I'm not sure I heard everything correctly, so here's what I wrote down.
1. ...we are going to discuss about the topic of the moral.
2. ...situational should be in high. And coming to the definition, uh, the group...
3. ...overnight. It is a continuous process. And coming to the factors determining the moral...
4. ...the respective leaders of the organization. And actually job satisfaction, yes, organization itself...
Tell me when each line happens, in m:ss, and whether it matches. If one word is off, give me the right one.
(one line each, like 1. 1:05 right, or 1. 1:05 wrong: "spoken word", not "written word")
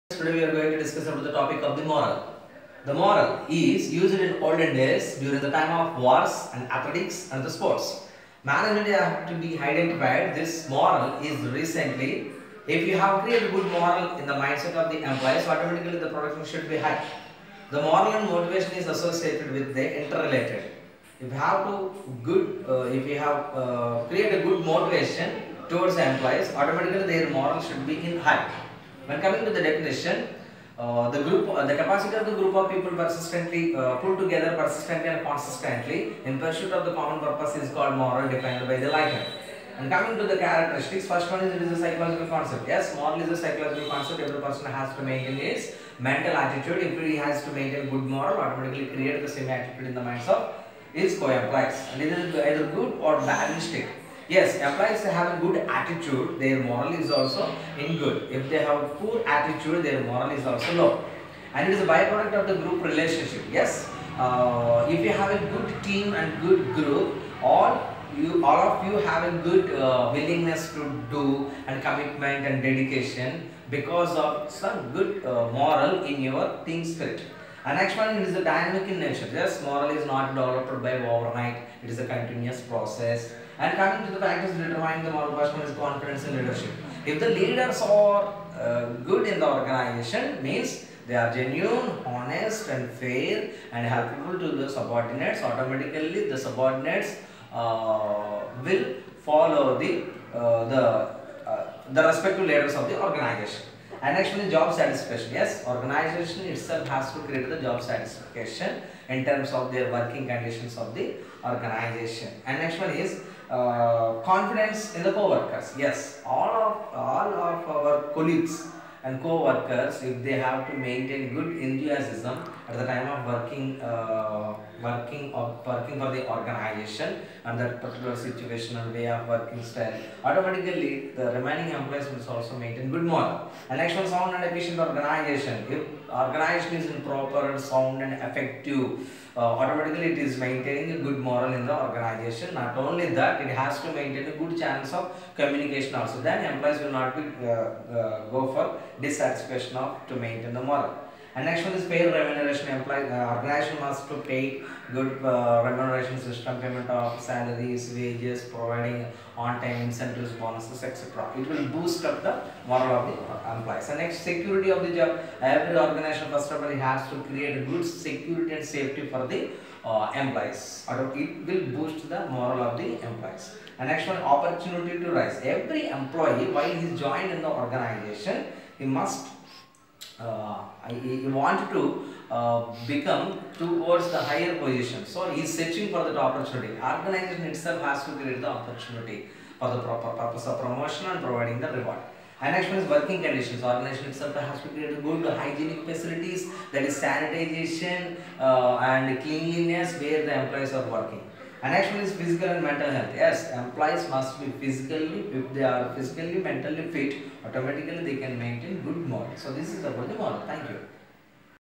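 1. 0:00 right
2. 0:27 wrong: "moral", not "situational"
3. 1:21 right
4. 1:41 right.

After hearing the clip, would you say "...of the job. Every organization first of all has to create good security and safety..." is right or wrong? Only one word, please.
right.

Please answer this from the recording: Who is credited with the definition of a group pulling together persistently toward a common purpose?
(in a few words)
Lycan.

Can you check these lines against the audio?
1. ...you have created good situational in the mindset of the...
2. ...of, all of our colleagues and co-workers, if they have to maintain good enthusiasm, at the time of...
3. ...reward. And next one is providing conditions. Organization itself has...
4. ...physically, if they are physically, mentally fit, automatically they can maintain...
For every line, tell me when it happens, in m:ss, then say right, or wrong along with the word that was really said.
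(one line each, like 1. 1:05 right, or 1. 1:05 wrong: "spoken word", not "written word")
1. 0:12 wrong: "moral", not "situational"
2. 1:56 right
3. 3:11 wrong: "working", not "providing"
4. 3:24 right.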